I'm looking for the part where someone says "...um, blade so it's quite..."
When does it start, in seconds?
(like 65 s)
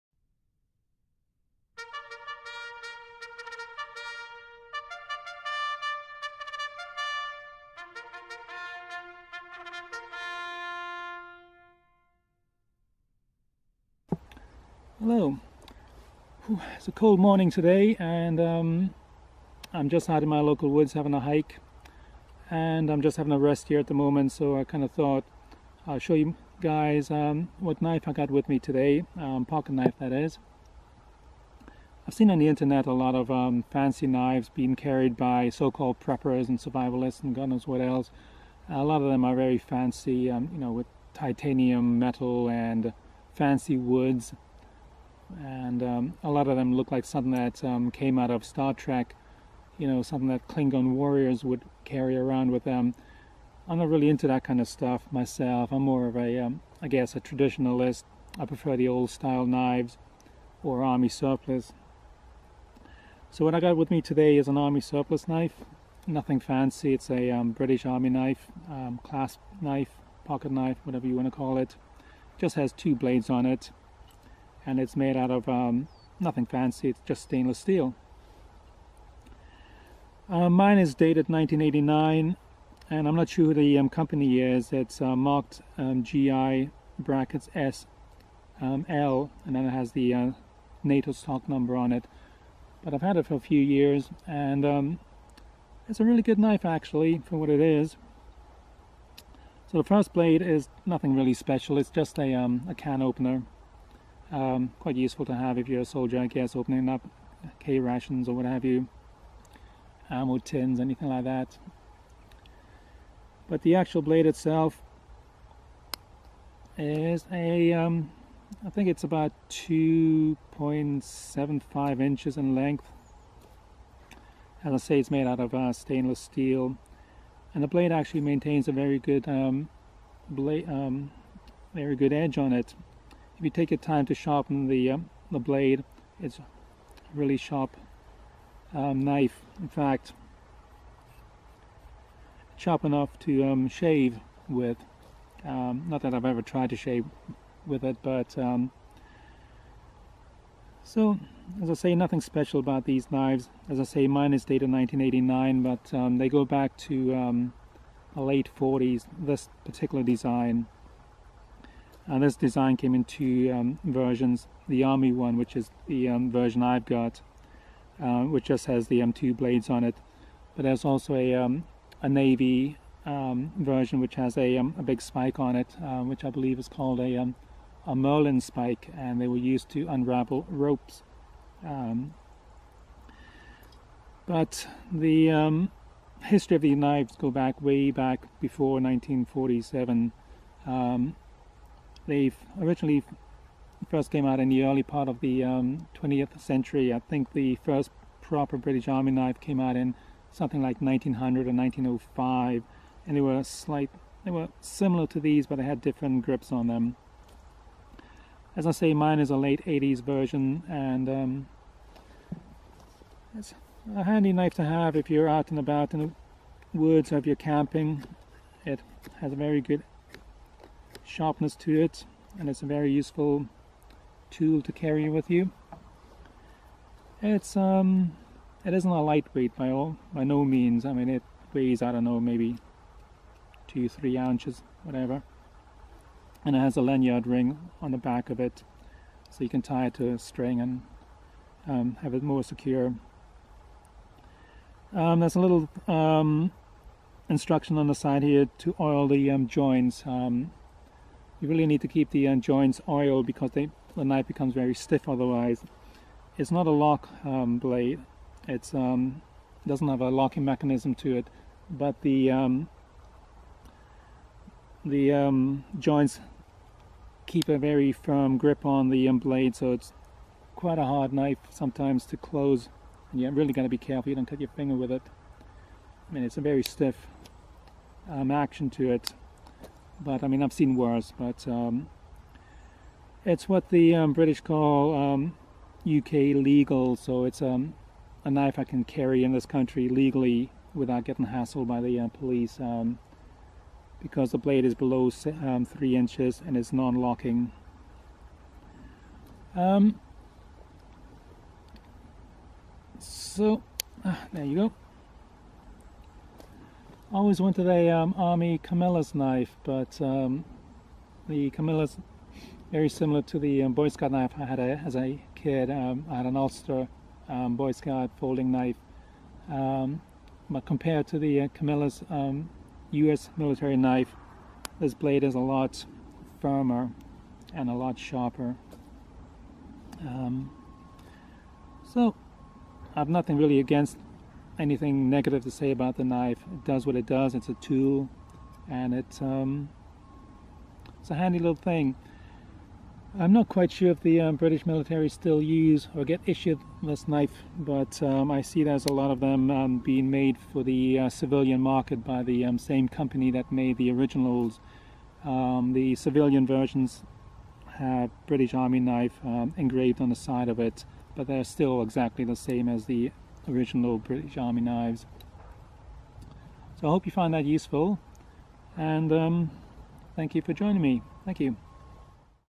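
269 s.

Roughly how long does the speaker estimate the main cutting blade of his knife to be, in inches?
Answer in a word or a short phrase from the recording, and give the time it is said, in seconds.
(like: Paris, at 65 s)
2.75 inches, at 119 s.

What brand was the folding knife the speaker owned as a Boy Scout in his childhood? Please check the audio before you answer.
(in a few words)
Ulster.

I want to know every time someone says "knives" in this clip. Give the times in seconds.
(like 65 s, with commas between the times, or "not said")
34 s, 59 s, 153 s, 186 s, 364 s.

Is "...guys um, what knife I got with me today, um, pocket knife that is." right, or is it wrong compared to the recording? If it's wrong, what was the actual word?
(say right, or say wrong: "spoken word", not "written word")
right.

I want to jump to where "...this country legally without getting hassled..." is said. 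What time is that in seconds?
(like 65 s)
289 s.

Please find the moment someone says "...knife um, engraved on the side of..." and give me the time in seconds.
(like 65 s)
358 s.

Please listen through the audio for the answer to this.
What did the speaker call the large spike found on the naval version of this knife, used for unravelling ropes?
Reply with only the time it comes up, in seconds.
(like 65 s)
177 s.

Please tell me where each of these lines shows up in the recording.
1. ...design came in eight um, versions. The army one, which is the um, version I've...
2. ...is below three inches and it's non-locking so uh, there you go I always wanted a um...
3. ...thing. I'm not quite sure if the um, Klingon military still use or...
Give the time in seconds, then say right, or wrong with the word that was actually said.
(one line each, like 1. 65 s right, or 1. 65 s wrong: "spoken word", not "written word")
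1. 162 s wrong: "two", not "eight"
2. 294 s right
3. 341 s wrong: "British", not "Klingon".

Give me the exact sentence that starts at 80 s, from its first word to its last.
Uh, mine is dated 1989 and I'm not sure who the um, company is.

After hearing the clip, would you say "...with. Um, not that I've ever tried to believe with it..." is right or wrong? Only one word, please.
wrong.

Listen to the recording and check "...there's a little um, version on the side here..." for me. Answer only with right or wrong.
wrong.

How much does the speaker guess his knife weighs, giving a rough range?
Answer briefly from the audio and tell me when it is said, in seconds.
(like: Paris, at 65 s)
2-3 ounces, at 233 s.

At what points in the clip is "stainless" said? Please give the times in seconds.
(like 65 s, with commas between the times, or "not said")
77 s, 125 s.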